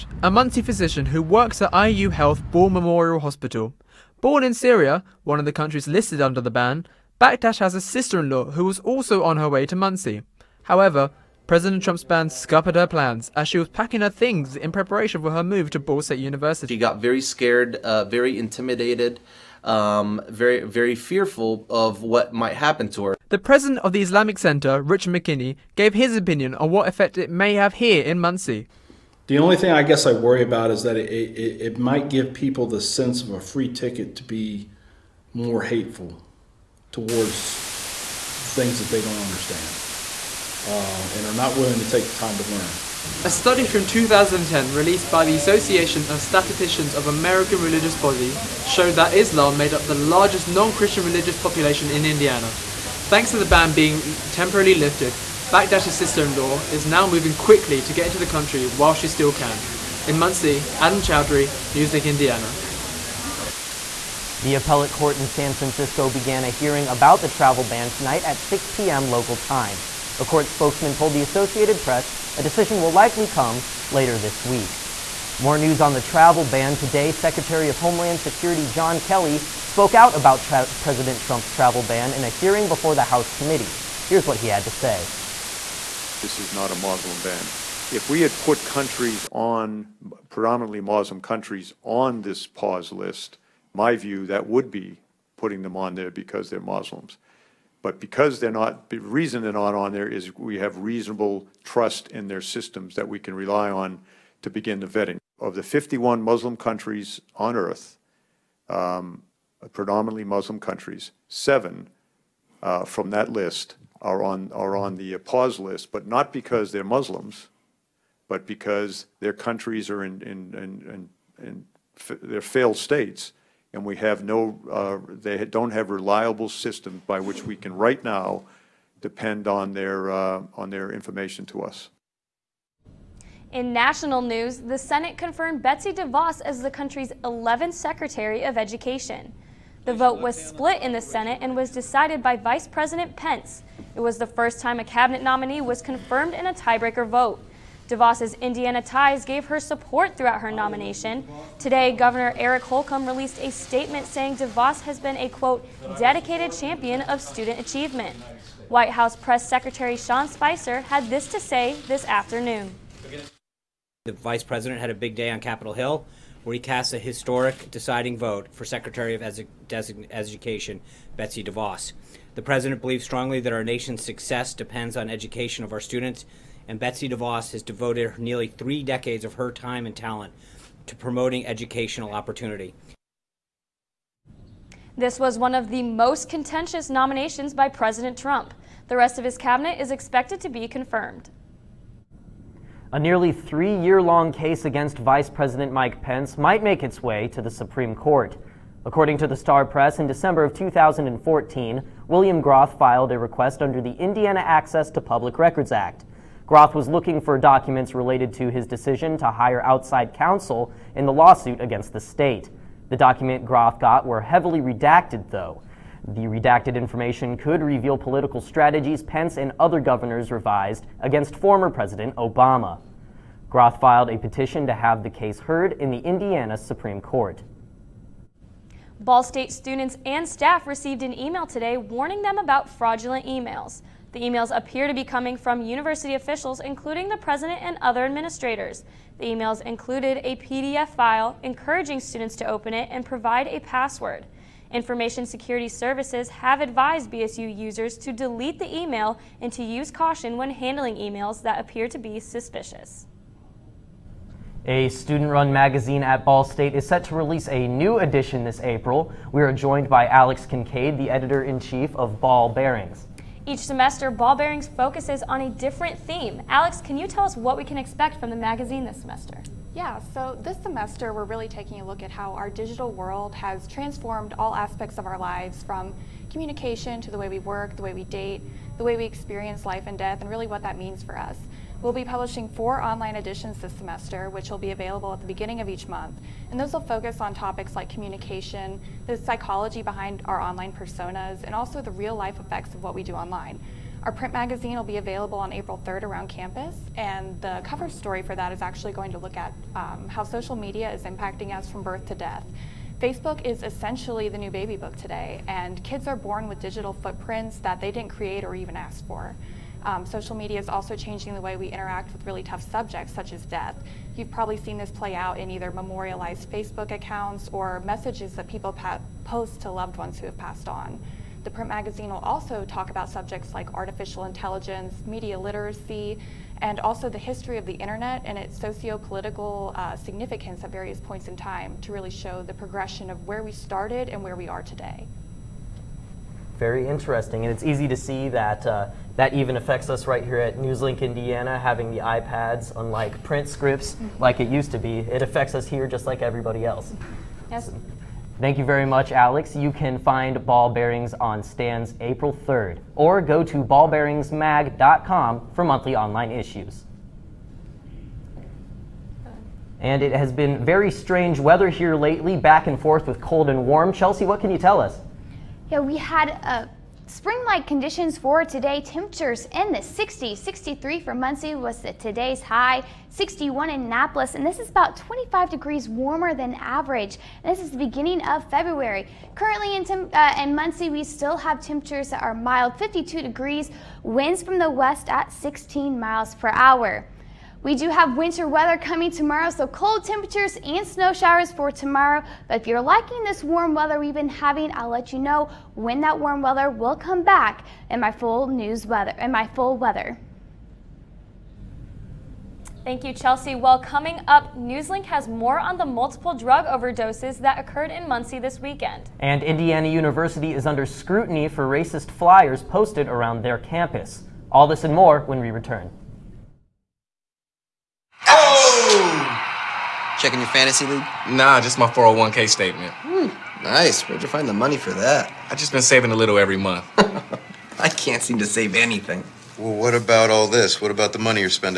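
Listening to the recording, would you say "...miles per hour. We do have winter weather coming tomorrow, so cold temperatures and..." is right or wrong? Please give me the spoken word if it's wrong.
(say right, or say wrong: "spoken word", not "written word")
right.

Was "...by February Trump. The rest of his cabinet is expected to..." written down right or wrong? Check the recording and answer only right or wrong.
wrong.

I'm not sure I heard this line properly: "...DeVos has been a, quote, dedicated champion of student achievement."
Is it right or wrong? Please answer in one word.
right.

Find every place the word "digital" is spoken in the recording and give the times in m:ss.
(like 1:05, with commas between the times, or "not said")
4:32, 5:06.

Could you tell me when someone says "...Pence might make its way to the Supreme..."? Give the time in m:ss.
3:16.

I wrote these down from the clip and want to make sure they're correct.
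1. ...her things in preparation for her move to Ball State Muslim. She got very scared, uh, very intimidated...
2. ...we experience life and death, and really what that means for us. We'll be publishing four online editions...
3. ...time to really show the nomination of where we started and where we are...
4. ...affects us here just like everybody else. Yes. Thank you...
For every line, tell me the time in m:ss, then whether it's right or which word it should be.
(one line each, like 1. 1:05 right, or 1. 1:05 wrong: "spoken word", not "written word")
1. 0:14 wrong: "University", not "Muslim"
2. 4:38 right
3. 5:31 wrong: "progression", not "nomination"
4. 5:45 right.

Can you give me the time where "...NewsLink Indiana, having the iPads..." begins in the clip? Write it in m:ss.
5:40.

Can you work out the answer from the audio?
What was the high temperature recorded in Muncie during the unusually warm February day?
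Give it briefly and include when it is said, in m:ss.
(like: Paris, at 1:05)
63, at 6:10.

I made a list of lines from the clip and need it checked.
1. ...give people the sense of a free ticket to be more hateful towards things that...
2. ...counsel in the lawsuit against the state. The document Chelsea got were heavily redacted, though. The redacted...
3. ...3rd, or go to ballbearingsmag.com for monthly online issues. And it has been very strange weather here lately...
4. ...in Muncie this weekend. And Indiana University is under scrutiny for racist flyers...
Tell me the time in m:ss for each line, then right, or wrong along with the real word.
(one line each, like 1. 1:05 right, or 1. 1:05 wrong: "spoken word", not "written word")
1. 0:32 right
2. 3:30 wrong: "Groth", not "Chelsea"
3. 5:52 right
4. 6:47 right.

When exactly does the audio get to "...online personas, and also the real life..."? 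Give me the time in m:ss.
4:50.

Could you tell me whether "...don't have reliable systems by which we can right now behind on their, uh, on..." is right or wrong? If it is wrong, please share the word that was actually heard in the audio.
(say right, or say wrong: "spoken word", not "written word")
wrong: "depend", not "behind".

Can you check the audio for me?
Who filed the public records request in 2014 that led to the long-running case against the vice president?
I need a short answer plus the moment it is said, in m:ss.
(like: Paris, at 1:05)
William Groth, at 3:22.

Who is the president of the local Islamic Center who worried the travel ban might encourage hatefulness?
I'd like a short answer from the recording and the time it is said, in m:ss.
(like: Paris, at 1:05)
Richard McKinney, at 0:24.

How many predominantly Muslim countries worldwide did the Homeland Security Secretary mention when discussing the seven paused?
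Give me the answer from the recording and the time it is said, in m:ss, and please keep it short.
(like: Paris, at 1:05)
51, at 1:45.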